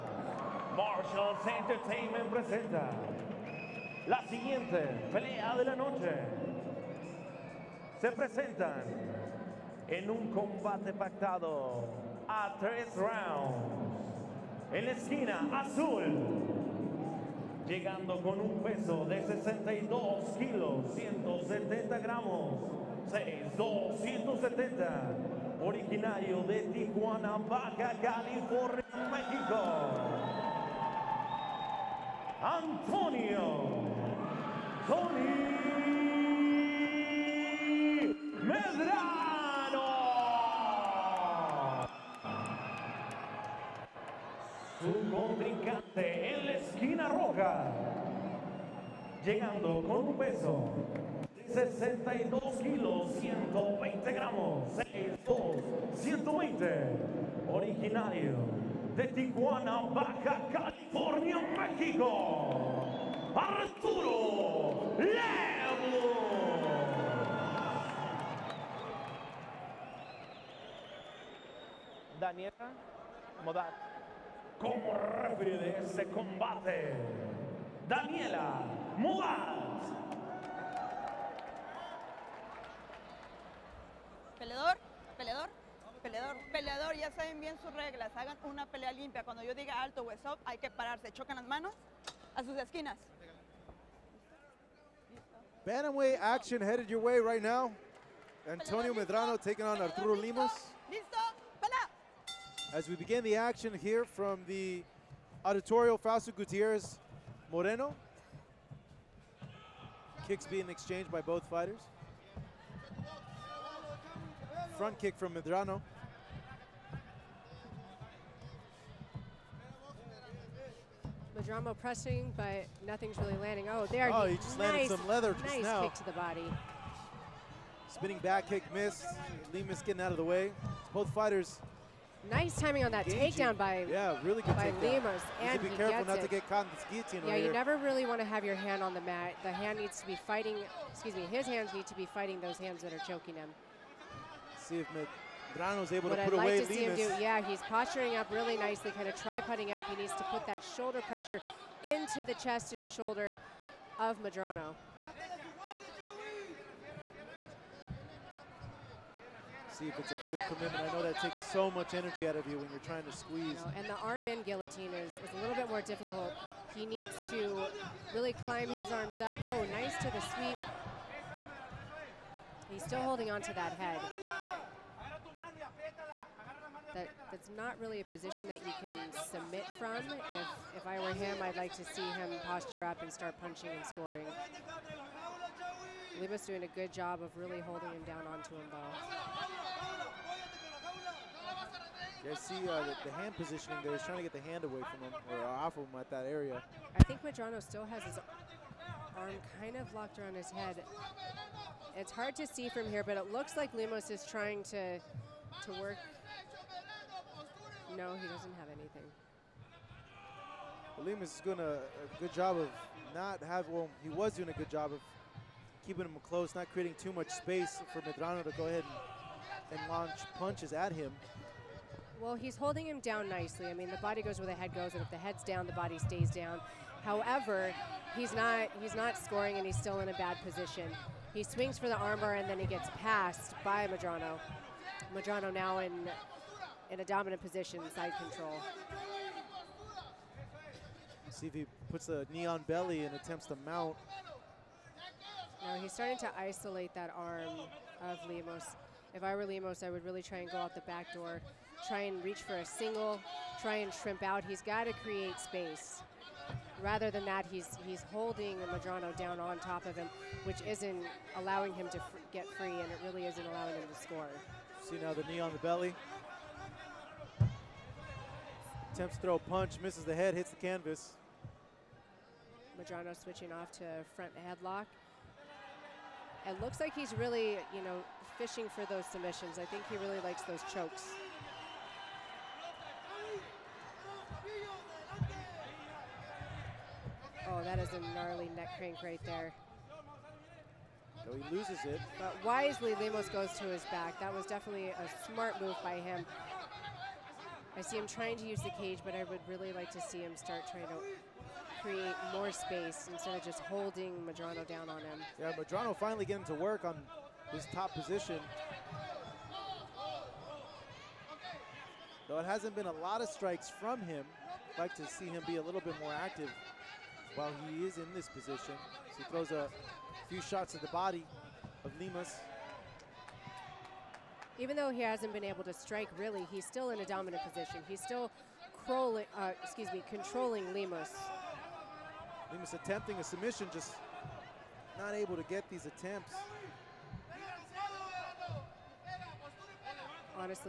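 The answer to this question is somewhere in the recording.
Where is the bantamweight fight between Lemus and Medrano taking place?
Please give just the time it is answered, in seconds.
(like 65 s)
105 s.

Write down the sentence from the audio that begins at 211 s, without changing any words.
Lemus is doing a, a good job of not have.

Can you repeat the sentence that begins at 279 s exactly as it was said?
I think he really likes those chokes.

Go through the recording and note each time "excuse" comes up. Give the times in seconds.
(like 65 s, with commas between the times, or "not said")
140 s, 329 s.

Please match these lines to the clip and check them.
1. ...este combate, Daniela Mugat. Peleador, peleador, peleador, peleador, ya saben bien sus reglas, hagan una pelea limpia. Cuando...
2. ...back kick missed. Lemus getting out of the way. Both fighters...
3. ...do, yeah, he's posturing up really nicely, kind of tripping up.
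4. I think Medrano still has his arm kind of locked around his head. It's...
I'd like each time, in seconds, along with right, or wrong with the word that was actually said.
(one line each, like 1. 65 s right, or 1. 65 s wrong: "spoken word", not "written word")
1. 75 s right
2. 128 s right
3. 146 s right
4. 196 s right.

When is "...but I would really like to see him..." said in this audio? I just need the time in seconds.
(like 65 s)
299 s.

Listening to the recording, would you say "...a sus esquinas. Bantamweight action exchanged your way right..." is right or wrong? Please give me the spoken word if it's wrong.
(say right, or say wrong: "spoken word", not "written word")
wrong: "headed", not "exchanged".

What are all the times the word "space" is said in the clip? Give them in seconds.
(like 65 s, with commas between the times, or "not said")
217 s, 255 s, 302 s.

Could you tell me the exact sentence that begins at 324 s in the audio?
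Even though he hasn't been able to strike really, he's still in a dominant position.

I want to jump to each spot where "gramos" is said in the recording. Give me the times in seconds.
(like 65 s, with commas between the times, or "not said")
21 s, 54 s.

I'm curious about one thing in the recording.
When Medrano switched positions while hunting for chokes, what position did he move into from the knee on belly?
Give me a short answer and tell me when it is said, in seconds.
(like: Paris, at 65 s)
Front headlock, at 274 s.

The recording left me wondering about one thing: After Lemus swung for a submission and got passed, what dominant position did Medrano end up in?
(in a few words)
Side control.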